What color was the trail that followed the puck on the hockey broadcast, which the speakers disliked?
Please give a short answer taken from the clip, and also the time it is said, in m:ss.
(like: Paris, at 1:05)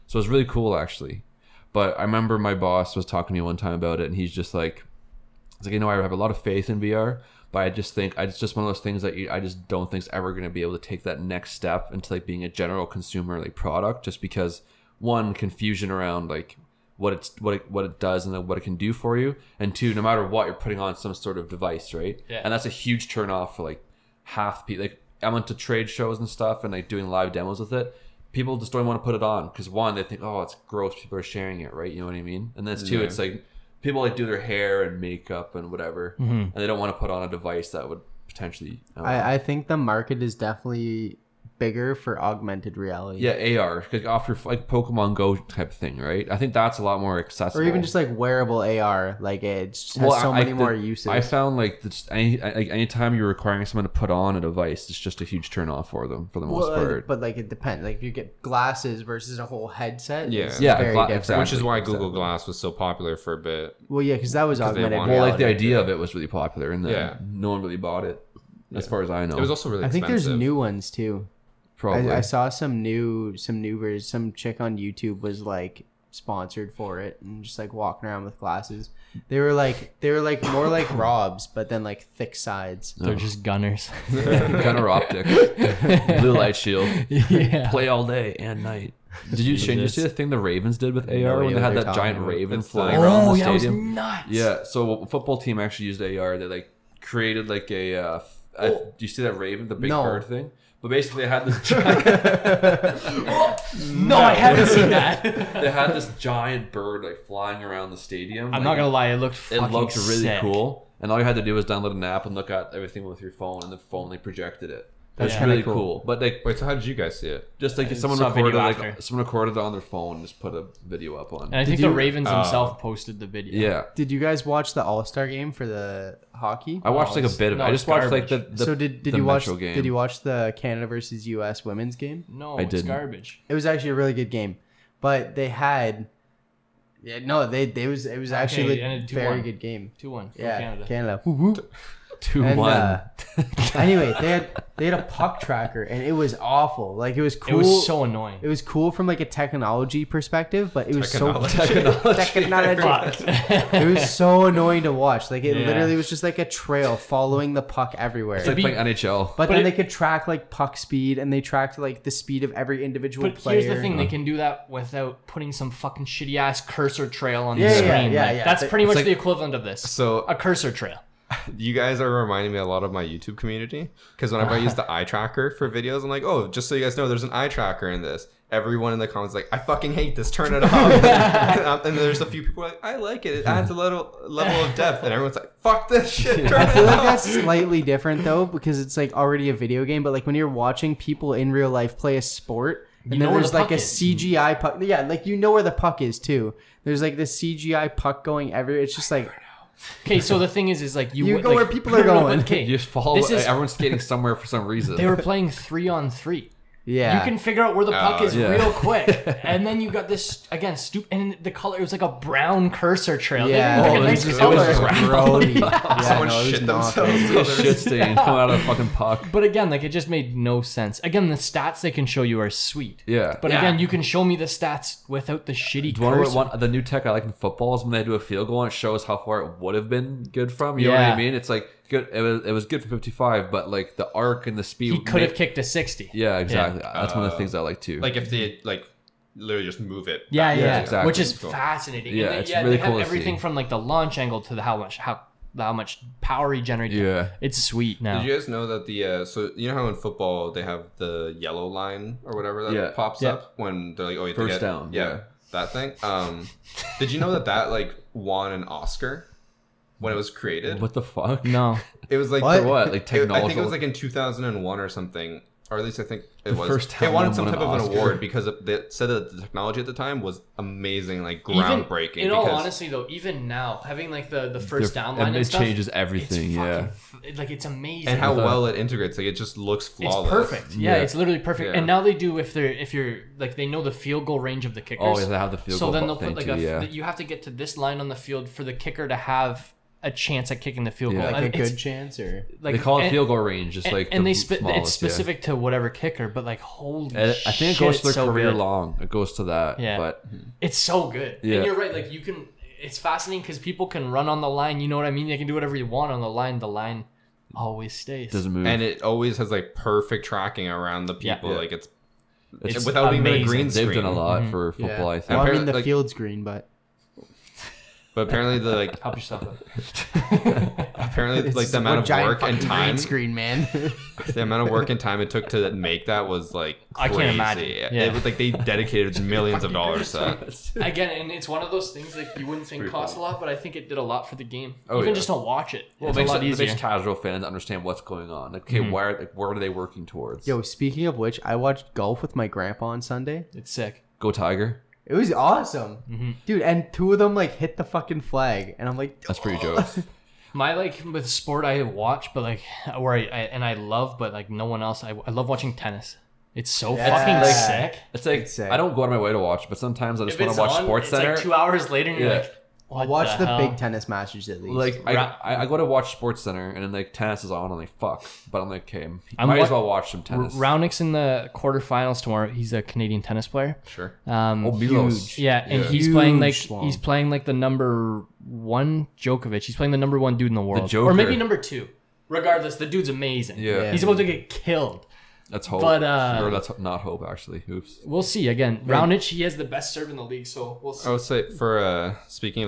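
Brown, at 3:32.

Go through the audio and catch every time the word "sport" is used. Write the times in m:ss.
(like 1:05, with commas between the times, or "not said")
3:12, 5:51, 6:00, 6:06.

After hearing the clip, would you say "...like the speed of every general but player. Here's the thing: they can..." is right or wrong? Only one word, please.
wrong.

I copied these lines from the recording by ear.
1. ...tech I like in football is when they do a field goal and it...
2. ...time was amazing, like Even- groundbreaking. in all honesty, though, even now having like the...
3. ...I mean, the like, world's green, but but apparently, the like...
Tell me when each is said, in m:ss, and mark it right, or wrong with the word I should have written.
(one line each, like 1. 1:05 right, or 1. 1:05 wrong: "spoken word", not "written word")
1. 3:46 right
2. 4:29 right
3. 5:15 wrong: "field", not "world".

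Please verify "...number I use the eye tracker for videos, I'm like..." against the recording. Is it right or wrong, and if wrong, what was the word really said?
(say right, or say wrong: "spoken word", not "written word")
wrong: "whenever", not "number".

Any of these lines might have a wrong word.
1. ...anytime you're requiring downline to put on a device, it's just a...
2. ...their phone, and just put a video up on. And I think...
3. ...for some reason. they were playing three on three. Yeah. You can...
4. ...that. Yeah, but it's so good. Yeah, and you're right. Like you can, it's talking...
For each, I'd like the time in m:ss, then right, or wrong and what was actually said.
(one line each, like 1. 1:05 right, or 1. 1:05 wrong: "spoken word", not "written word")
1. 0:52 wrong: "someone", not "downline"
2. 1:59 right
3. 3:24 right
4. 4:59 wrong: "fascinating", not "talking".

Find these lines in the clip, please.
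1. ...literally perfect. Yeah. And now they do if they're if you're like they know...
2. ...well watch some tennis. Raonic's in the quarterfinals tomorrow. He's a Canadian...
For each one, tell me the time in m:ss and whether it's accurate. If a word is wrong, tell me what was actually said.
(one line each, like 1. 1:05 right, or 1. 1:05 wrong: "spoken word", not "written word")
1. 4:41 right
2. 6:09 right.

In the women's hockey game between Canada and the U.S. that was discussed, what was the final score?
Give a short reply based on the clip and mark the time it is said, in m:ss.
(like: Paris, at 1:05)
2-1, at 2:19.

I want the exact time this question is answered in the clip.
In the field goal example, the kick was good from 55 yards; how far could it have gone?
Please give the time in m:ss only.
3:55.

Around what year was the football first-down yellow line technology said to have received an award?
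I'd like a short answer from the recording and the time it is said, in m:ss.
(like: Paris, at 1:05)
2001, at 4:23.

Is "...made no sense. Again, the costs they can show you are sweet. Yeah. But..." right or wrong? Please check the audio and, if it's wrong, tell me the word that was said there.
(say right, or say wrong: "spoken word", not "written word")
wrong: "stats", not "costs".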